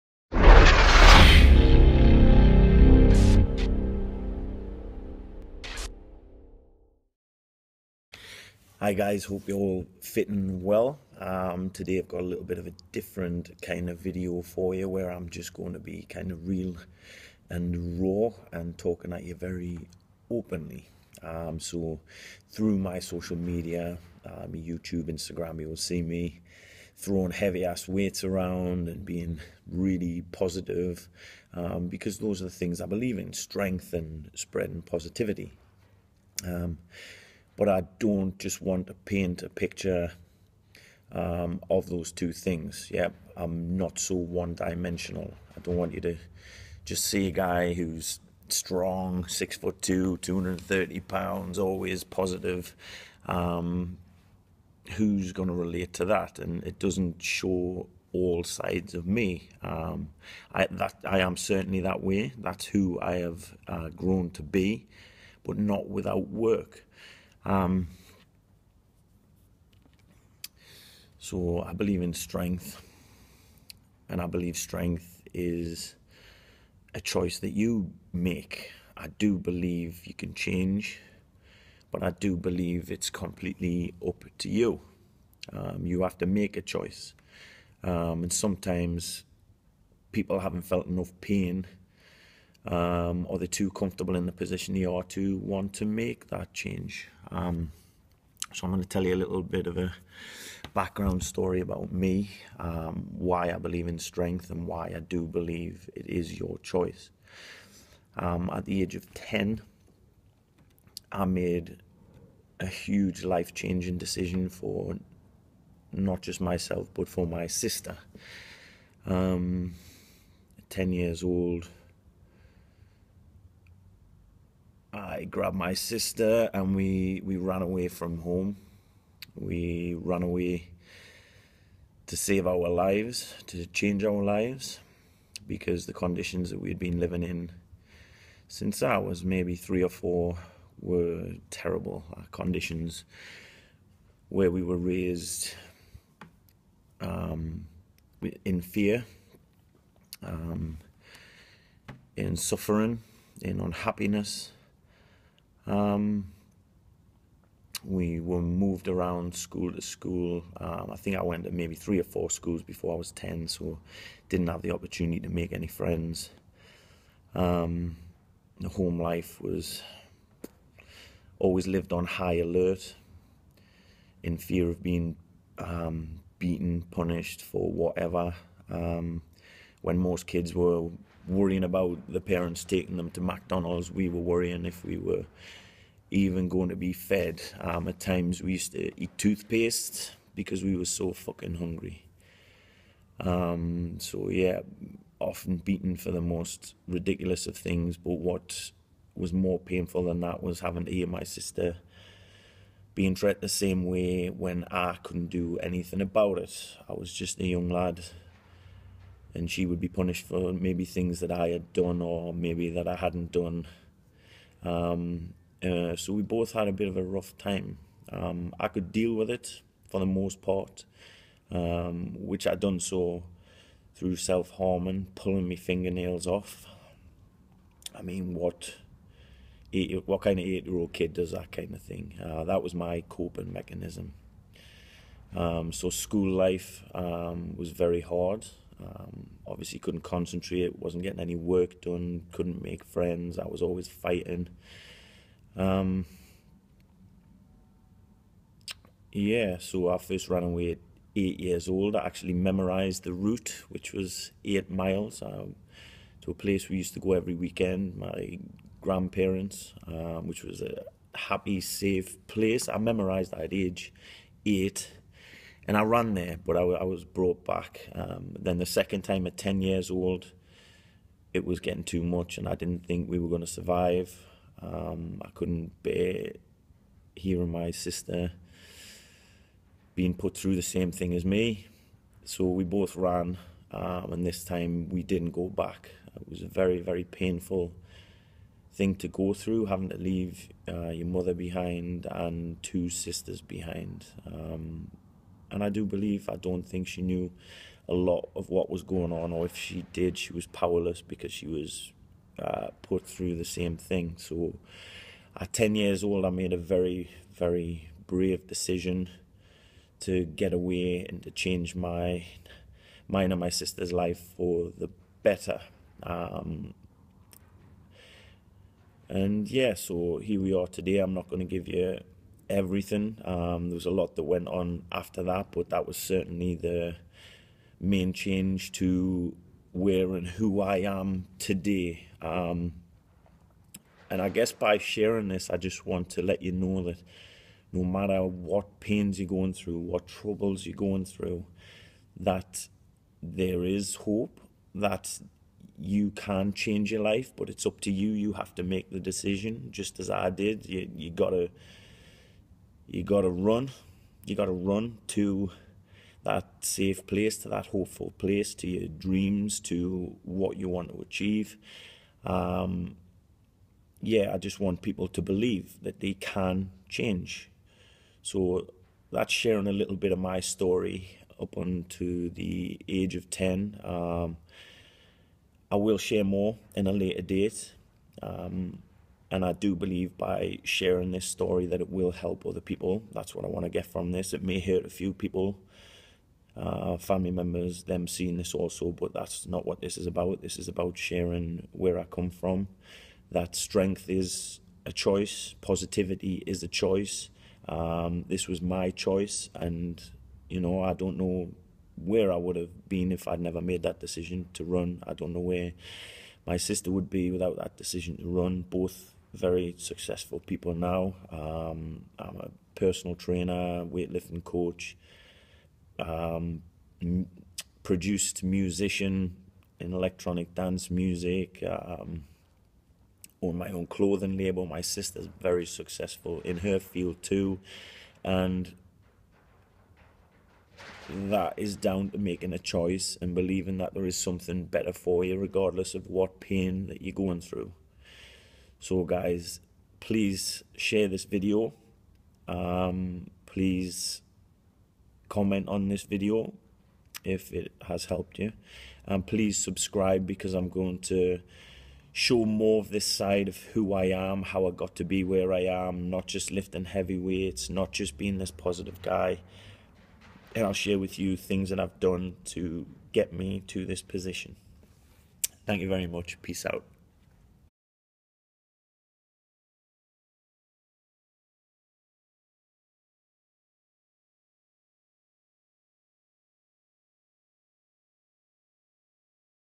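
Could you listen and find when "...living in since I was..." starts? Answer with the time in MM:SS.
02:16.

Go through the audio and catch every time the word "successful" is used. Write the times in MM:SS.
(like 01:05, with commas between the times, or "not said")
06:49, 07:05.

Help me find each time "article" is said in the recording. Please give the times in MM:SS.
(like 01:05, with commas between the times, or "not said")
not said.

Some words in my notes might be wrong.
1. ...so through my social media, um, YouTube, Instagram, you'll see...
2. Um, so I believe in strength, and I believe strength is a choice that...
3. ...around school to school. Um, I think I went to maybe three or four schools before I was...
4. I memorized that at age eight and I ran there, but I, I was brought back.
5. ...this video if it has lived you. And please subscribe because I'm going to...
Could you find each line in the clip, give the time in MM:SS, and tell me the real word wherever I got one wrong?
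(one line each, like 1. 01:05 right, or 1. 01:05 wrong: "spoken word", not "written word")
1. 00:21 right
2. 01:07 right
3. 02:38 right
4. 04:22 right
5. 07:25 wrong: "helped", not "lived".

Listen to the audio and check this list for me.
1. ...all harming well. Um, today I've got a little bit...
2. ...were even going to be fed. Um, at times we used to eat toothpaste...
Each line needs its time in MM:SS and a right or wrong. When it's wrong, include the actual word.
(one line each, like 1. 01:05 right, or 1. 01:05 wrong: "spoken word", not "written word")
1. 00:09 wrong: "fitting", not "harming"
2. 03:04 right.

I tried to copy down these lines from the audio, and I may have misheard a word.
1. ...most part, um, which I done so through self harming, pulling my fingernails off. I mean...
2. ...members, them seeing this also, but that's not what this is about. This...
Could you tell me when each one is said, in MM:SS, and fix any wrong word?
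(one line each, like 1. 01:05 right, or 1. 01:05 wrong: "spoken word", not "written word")
1. 03:40 right
2. 06:27 right.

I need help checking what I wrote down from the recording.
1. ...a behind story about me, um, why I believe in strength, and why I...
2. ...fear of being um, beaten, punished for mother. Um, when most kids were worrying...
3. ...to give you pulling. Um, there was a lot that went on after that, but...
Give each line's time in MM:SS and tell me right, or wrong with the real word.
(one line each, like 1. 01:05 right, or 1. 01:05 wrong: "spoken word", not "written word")
1. 01:39 wrong: "background", not "behind"
2. 02:54 wrong: "whatever", not "mother"
3. 05:21 wrong: "everything", not "pulling".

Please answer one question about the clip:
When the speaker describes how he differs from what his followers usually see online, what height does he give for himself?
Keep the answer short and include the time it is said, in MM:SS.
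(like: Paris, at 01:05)
6 foot 2, at 00:49.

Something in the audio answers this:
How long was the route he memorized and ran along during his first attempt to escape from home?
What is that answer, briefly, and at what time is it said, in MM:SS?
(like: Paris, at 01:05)
8 miles, at 04:14.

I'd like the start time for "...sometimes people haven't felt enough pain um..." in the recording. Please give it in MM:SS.
01:28.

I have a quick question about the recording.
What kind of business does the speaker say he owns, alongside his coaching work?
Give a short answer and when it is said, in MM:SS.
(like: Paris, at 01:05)
Clothing label, at 07:03.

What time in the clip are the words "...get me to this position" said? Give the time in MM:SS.
07:43.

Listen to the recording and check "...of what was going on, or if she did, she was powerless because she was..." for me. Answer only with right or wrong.
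right.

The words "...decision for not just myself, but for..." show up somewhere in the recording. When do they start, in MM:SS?
01:53.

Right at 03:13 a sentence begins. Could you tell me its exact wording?
Um, so yeah, often beaten for the most ridiculous of things.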